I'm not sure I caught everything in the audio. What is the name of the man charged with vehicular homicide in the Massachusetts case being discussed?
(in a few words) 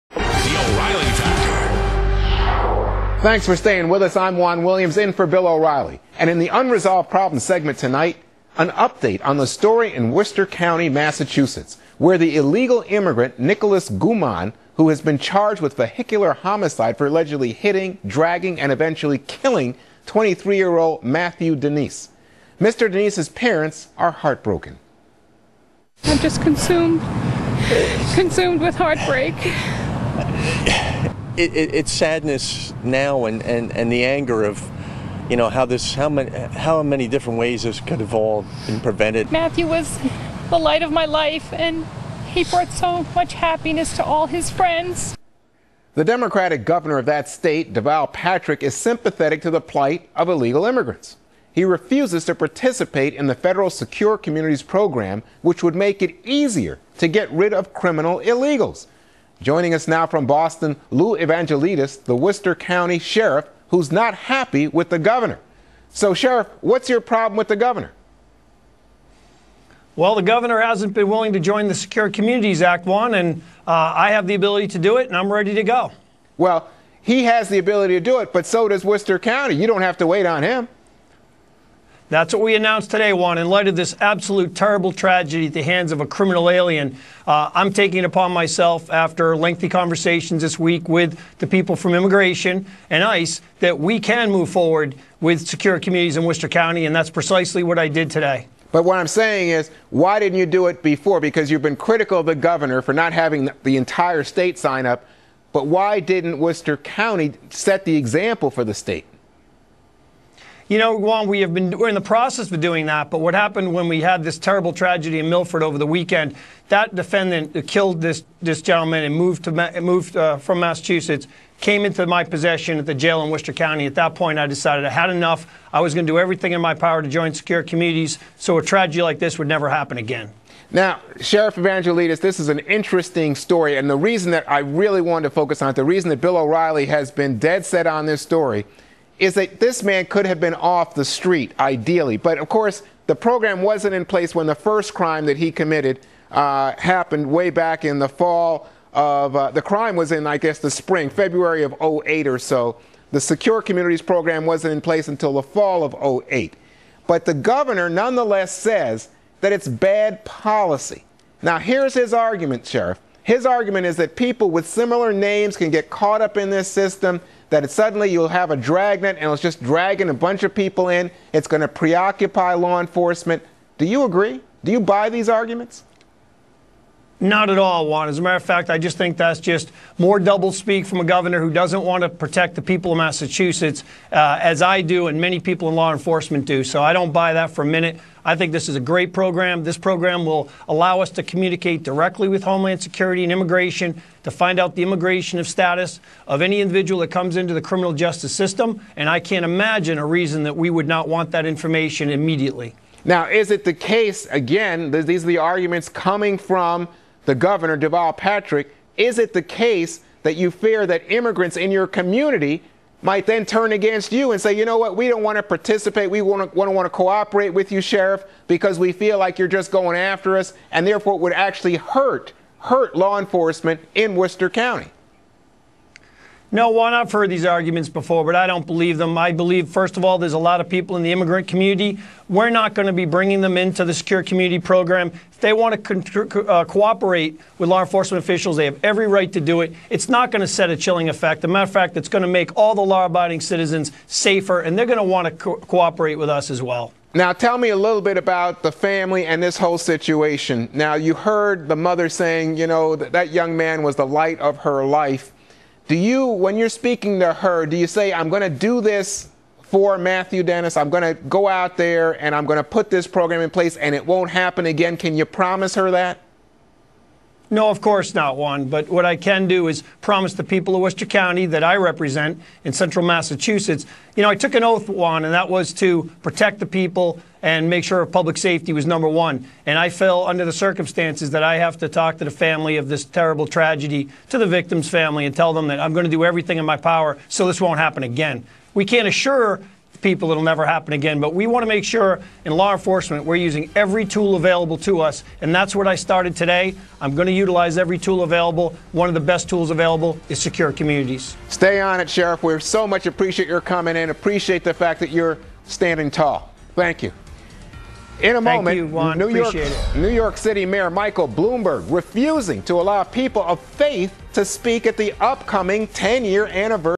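Nicolas Guaman.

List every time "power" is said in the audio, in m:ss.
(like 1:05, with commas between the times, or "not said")
2:06, 4:46.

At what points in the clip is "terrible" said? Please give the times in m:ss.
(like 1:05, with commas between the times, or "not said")
1:24, 1:54, 4:43.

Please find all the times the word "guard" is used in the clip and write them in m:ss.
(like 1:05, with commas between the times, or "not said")
not said.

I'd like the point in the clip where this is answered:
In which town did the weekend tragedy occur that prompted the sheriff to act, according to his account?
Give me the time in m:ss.
1:55.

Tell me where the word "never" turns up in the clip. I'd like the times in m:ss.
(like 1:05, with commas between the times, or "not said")
2:09, 4:50.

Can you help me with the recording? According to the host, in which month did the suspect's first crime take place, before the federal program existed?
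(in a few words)
February.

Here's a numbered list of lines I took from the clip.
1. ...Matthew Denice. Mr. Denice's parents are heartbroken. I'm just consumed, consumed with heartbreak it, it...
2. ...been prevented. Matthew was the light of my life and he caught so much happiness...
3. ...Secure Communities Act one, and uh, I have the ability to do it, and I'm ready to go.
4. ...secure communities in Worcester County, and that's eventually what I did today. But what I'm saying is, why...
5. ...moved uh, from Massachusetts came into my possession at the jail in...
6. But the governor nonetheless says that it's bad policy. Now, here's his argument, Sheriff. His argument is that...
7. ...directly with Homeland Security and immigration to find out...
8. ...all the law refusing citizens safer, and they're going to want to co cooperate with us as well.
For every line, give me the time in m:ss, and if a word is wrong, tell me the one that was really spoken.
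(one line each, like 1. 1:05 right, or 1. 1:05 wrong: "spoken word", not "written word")
1. 0:21 right
2. 0:38 wrong: "brought", not "caught"
3. 1:11 right
4. 1:35 wrong: "precisely", not "eventually"
5. 1:59 right
6. 2:37 right
7. 3:11 right
8. 4:02 wrong: "abiding", not "refusing".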